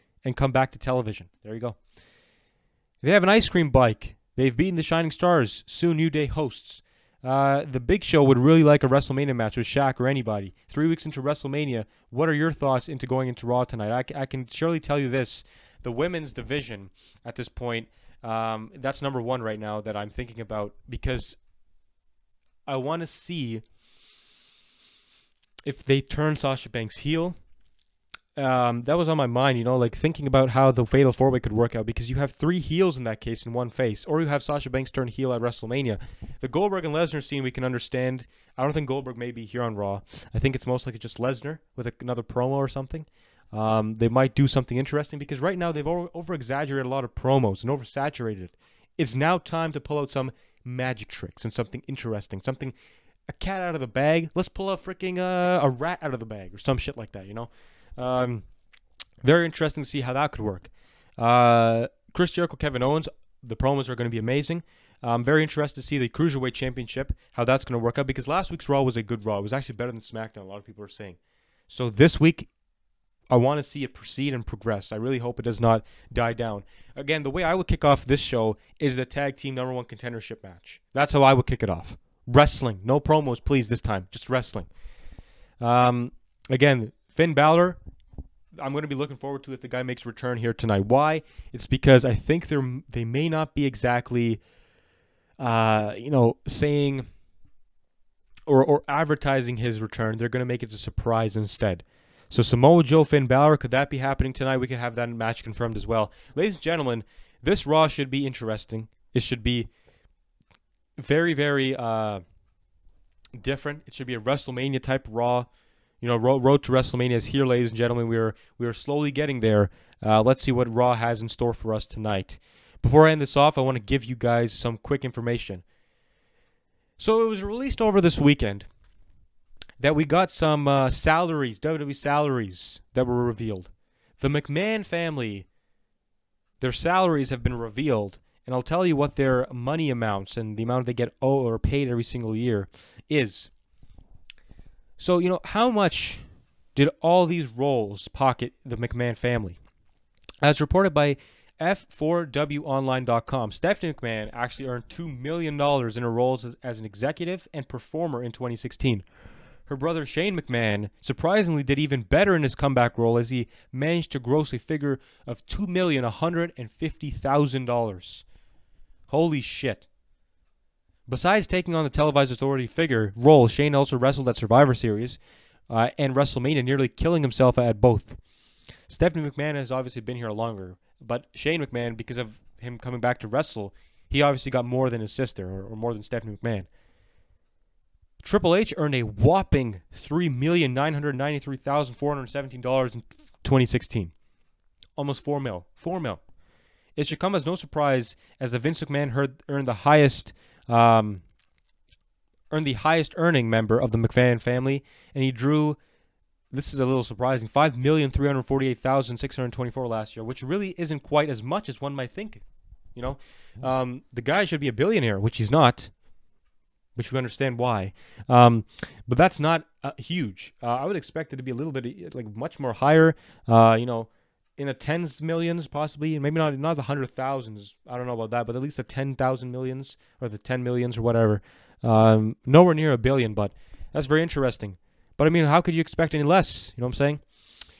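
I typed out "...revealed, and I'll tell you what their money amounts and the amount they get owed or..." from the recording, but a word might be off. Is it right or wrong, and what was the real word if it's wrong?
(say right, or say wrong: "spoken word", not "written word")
right.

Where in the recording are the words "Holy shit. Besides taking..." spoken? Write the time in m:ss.
2:49.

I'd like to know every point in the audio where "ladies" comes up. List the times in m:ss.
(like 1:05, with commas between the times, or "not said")
1:46, 1:57.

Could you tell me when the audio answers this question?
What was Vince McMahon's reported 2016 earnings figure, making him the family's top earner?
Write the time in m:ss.
3:27.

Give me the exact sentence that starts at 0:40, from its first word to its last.
I think it's most likely just Lesnar with a, another promo or something.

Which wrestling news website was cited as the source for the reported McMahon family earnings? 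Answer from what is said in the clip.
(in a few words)
F4WOnline.com.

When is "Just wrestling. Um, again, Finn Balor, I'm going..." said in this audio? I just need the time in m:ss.
1:24.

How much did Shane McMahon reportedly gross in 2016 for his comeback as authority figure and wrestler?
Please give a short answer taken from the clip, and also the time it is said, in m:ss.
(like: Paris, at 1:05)
$2,150,000, at 2:45.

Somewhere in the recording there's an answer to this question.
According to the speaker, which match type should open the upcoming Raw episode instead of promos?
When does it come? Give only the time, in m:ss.
1:19.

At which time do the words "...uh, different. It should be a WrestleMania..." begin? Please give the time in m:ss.
1:51.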